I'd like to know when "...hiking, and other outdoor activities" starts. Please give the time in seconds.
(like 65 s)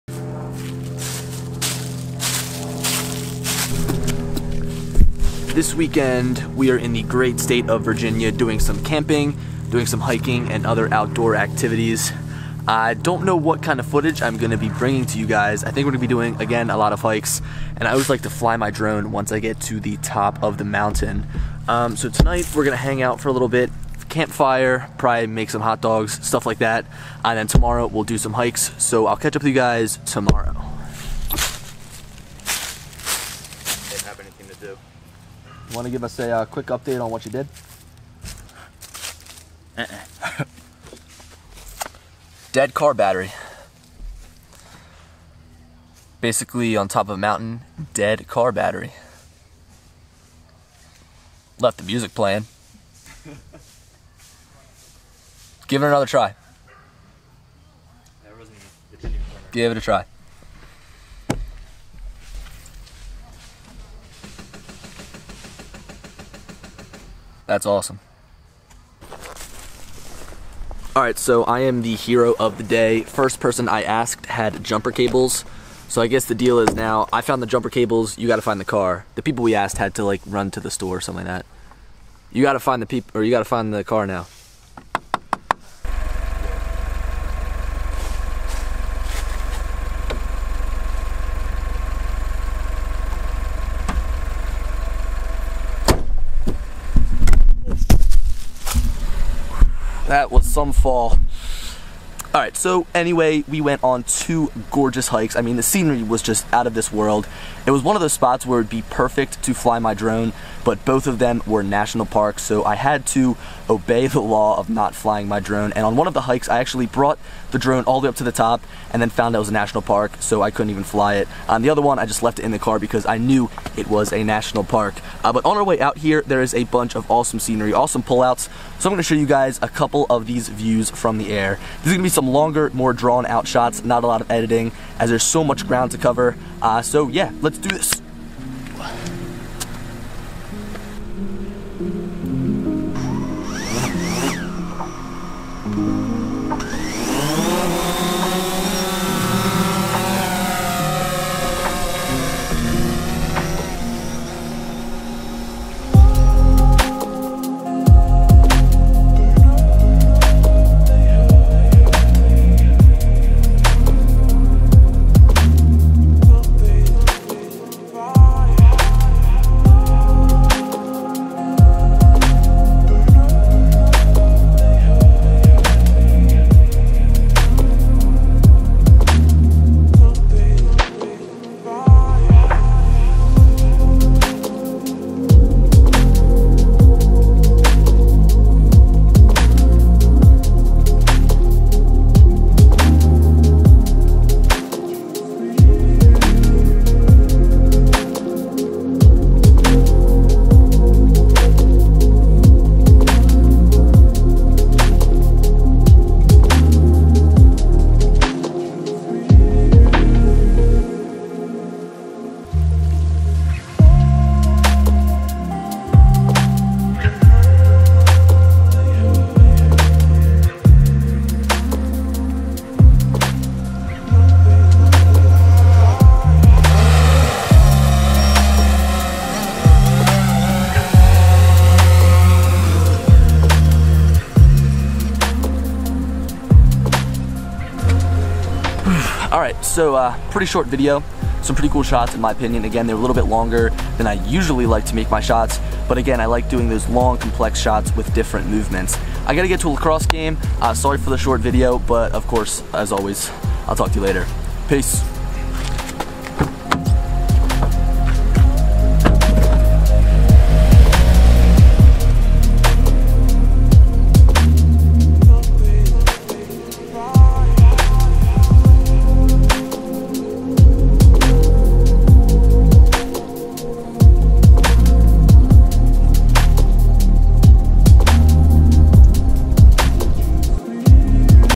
9 s.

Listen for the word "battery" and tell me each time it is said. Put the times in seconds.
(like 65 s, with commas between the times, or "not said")
42 s, 48 s.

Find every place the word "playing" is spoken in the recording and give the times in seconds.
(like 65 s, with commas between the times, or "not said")
52 s.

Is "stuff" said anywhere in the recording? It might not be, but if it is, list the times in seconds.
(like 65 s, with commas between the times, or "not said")
26 s.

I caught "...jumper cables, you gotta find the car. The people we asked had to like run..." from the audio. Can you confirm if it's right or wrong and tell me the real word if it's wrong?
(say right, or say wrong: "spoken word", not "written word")
right.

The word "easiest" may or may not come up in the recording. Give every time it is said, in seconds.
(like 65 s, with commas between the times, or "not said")
not said.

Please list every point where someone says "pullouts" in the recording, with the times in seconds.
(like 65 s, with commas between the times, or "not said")
128 s.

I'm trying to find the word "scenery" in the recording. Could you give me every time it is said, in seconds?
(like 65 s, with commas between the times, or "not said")
105 s, 127 s.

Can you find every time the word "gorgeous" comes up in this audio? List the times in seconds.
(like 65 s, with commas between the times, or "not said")
104 s.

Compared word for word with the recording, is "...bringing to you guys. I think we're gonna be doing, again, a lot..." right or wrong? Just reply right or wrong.
right.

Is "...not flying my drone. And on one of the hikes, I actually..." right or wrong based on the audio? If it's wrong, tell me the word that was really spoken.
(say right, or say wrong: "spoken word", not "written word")
right.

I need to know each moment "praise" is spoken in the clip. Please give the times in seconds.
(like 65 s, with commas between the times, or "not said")
not said.